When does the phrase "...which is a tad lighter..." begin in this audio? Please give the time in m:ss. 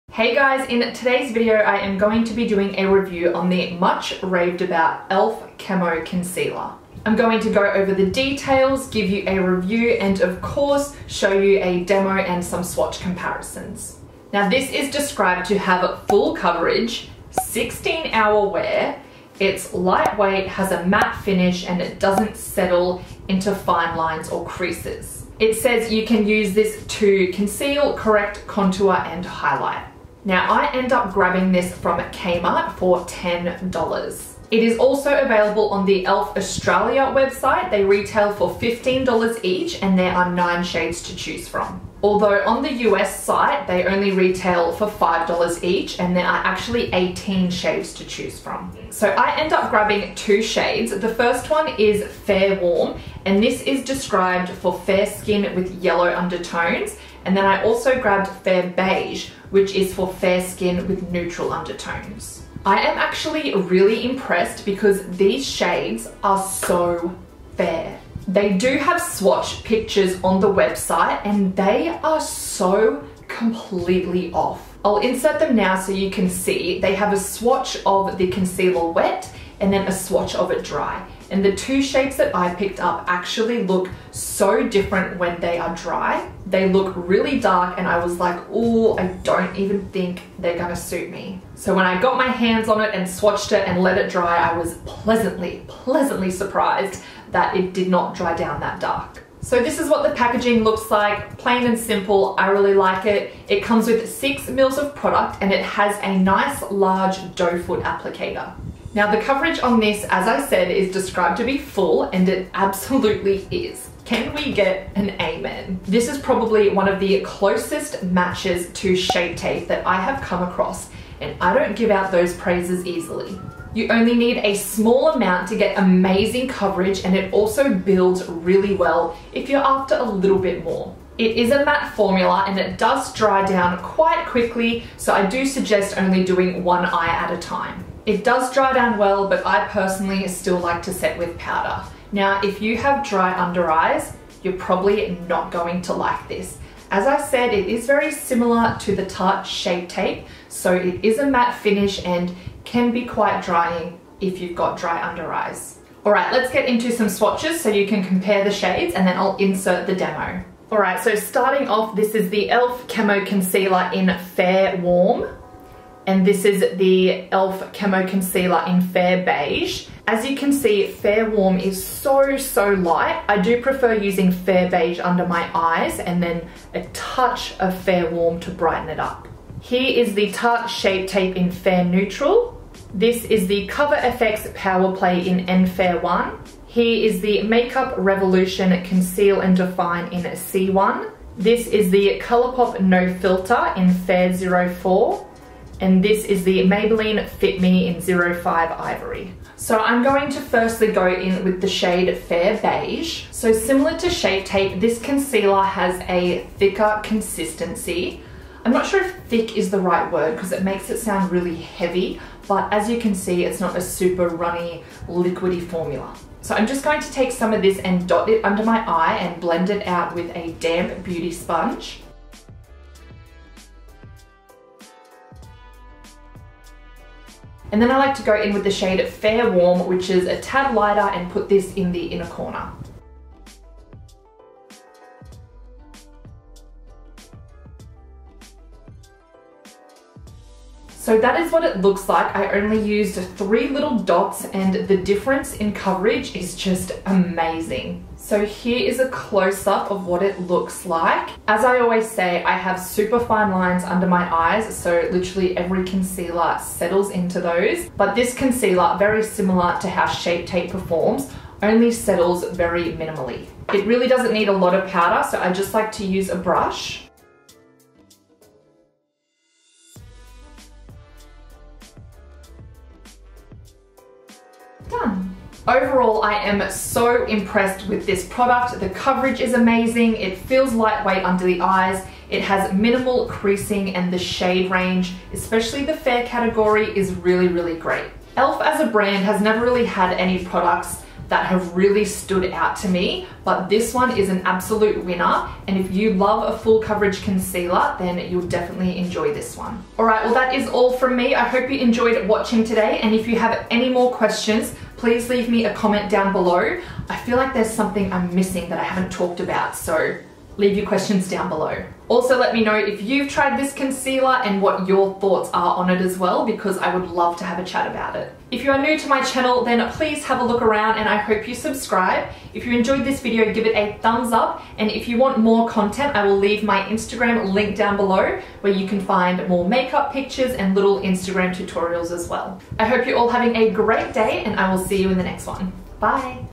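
3:49.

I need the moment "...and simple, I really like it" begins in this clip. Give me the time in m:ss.
1:41.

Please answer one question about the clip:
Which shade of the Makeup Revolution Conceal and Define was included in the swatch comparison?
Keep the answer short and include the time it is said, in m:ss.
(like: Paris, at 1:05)
C1, at 3:10.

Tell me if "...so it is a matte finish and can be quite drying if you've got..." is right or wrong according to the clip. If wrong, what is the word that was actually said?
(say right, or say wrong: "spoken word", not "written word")
right.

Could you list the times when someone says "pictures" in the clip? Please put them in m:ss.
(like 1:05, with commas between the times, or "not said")
1:09, 5:30.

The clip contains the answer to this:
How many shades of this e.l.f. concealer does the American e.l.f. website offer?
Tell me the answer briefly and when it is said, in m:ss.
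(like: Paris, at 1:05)
18, at 0:46.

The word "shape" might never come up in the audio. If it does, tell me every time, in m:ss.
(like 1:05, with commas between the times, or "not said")
1:21, 1:58, 2:29, 3:00, 3:24, 4:20.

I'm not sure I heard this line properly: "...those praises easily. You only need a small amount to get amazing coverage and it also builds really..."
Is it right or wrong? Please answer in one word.
right.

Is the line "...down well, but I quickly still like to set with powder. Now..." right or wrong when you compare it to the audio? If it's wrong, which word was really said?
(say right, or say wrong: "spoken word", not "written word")
wrong: "personally", not "quickly".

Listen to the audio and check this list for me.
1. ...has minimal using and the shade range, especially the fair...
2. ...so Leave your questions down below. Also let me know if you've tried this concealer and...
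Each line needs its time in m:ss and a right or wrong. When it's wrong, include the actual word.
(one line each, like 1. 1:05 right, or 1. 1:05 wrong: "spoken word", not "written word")
1. 4:42 wrong: "creasing", not "using"
2. 5:09 right.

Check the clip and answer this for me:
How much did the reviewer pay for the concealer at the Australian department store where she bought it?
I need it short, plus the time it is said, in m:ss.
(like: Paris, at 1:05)
$10, at 0:33.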